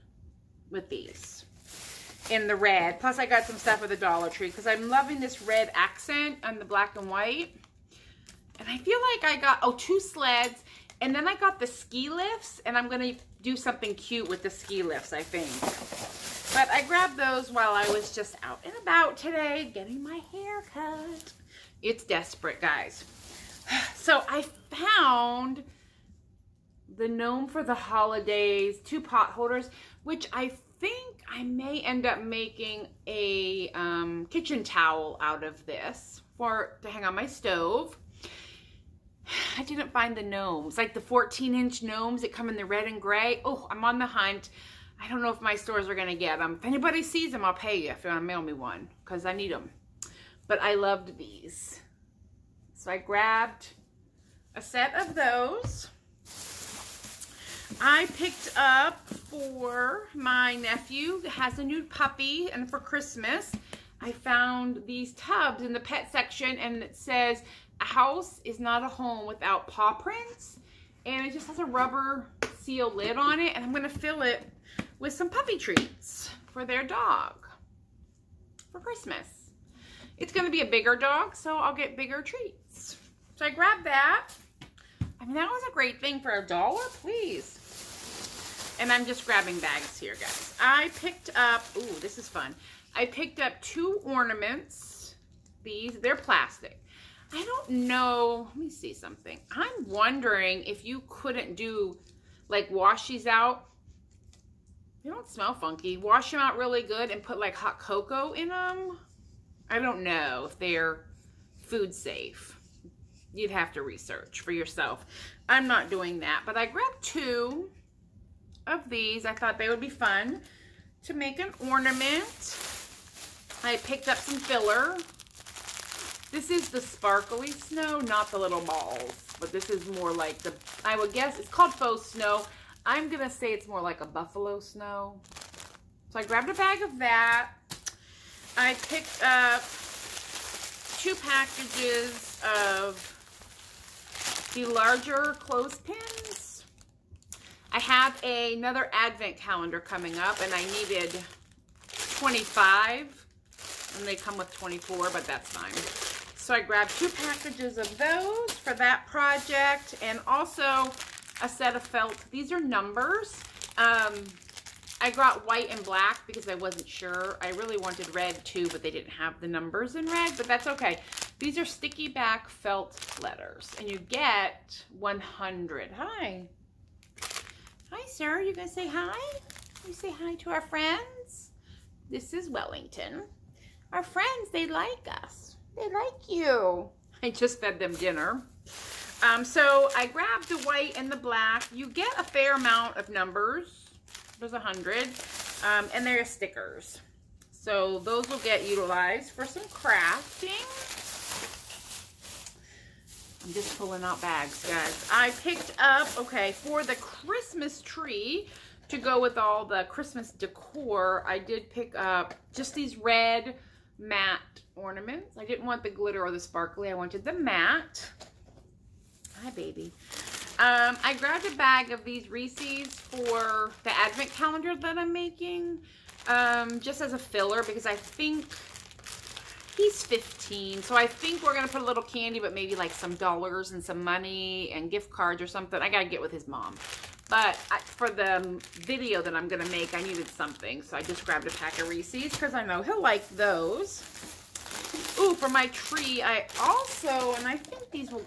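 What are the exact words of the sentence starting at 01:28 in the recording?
And I'm just grabbing bags here, guys.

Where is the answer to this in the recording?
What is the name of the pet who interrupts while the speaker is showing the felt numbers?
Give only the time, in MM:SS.
03:02.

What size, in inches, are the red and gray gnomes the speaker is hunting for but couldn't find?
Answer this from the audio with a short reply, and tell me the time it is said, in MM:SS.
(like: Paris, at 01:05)
14 inch, at 00:40.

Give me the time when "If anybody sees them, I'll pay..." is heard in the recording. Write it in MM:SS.
00:46.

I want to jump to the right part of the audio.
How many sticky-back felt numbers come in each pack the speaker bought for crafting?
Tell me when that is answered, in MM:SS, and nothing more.
02:54.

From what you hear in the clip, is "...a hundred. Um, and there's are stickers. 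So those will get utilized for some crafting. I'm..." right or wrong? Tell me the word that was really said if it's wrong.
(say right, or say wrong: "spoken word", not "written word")
right.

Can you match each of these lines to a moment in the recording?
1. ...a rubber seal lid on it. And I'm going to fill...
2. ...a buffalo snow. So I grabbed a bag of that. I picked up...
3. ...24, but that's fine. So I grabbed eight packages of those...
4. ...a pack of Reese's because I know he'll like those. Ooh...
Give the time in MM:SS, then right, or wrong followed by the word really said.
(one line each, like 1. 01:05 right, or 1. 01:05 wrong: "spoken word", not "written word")
1. 01:11 right
2. 02:13 right
3. 02:34 wrong: "two", not "eight"
4. 04:01 right.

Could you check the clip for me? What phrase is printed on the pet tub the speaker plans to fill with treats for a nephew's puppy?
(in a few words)
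A house is not a home without paw prints.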